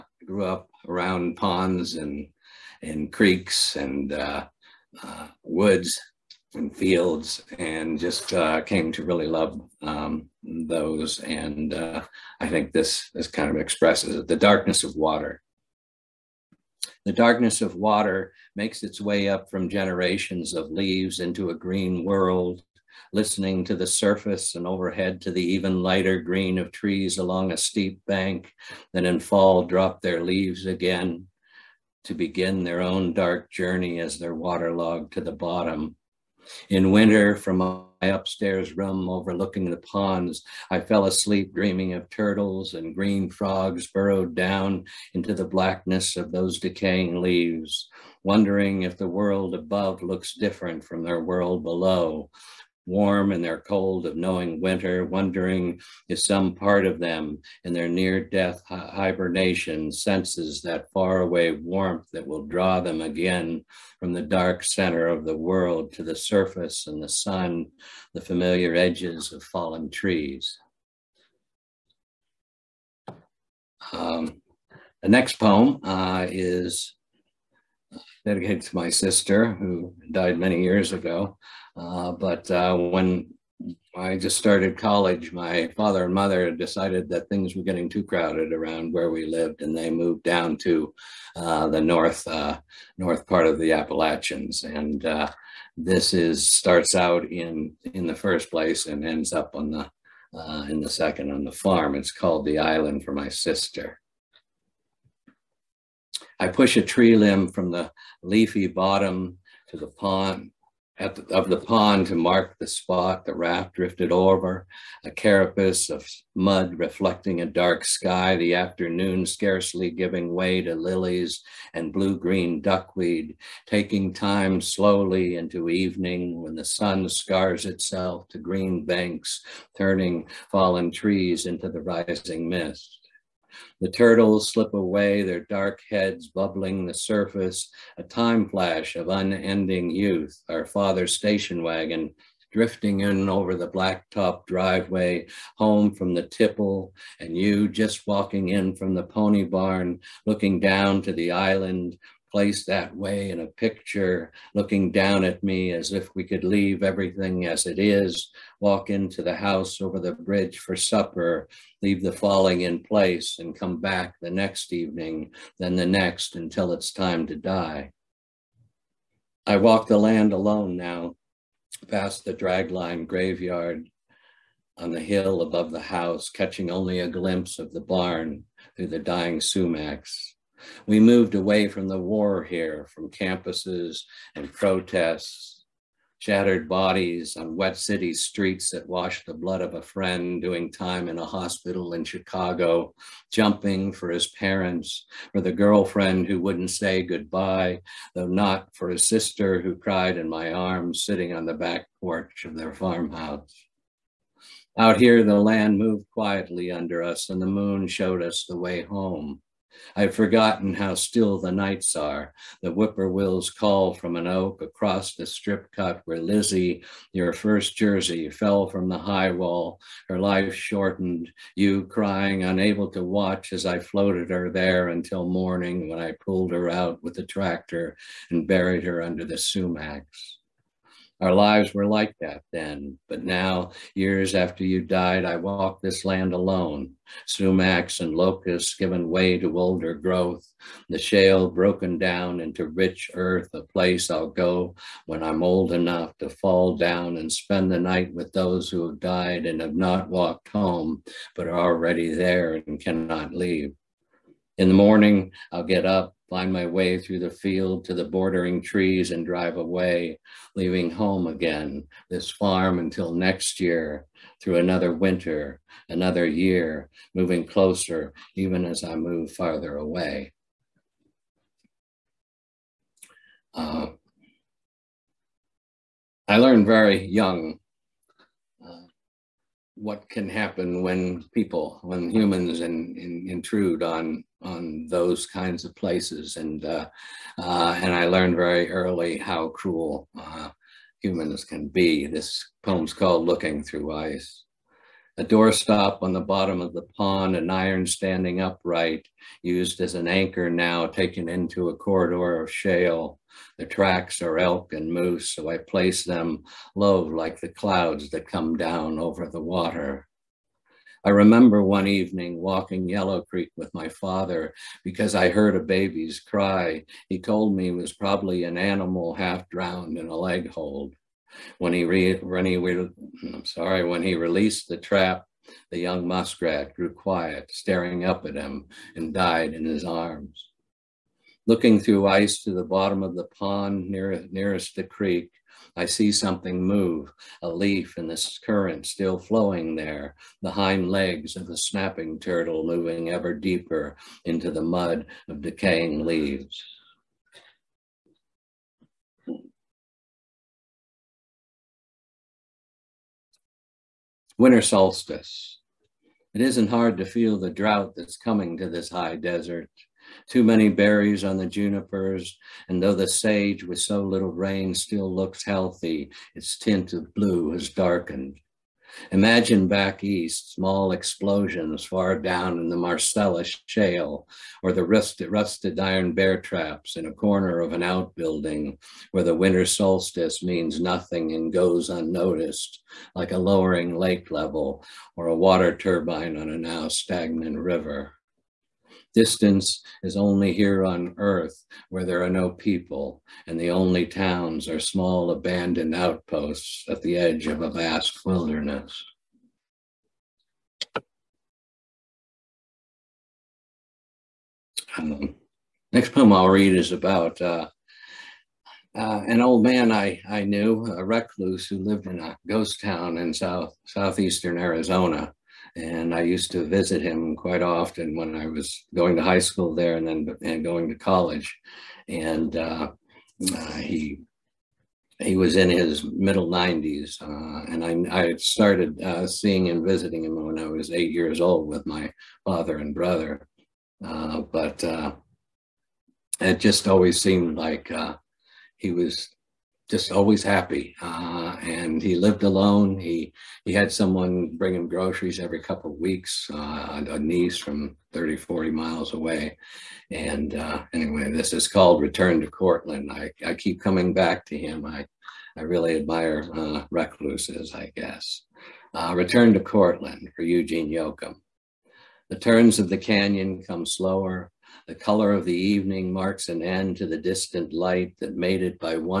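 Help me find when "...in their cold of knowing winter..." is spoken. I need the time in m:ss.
0:53.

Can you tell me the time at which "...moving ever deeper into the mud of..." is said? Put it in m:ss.
5:42.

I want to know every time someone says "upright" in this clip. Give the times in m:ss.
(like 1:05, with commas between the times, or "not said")
4:58.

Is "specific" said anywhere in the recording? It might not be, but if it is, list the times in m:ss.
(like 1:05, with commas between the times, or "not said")
not said.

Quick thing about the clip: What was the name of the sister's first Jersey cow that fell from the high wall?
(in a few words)
Lizzie.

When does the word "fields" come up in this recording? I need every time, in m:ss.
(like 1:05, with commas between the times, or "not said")
0:06, 4:17.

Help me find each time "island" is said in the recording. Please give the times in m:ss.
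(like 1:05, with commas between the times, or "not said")
1:42, 2:31.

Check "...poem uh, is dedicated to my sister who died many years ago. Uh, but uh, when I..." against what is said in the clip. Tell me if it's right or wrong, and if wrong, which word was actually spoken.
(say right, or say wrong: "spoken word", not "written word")
right.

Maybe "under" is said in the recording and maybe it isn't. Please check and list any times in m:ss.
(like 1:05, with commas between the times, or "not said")
3:26, 3:49.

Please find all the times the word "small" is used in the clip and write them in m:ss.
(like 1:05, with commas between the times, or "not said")
6:10, 6:34.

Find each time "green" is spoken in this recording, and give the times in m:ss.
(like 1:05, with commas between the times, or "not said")
0:21, 0:26, 0:42, 2:02, 2:08.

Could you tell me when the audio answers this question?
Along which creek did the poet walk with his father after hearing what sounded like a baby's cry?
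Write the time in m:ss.
5:12.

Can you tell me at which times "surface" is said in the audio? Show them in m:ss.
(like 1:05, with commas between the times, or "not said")
0:23, 1:06, 2:16.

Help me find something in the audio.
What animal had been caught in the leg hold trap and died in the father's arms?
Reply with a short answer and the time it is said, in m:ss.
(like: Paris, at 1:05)
muskrat, at 5:26.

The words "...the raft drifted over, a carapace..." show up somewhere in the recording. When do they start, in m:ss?
1:53.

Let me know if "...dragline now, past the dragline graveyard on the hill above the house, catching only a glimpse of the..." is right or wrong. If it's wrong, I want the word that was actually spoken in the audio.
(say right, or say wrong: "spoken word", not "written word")
wrong: "alone", not "dragline".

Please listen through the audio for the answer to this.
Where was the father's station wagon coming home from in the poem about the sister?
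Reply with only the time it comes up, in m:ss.
2:26.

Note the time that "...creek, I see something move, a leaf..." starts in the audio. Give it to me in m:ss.
5:34.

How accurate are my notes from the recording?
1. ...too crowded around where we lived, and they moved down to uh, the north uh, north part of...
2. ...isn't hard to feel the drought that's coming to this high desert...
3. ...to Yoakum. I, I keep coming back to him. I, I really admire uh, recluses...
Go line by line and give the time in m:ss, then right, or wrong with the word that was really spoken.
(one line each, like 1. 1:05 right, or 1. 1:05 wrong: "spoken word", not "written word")
1. 1:27 right
2. 5:56 right
3. 7:32 wrong: "Courtland", not "Yoakum".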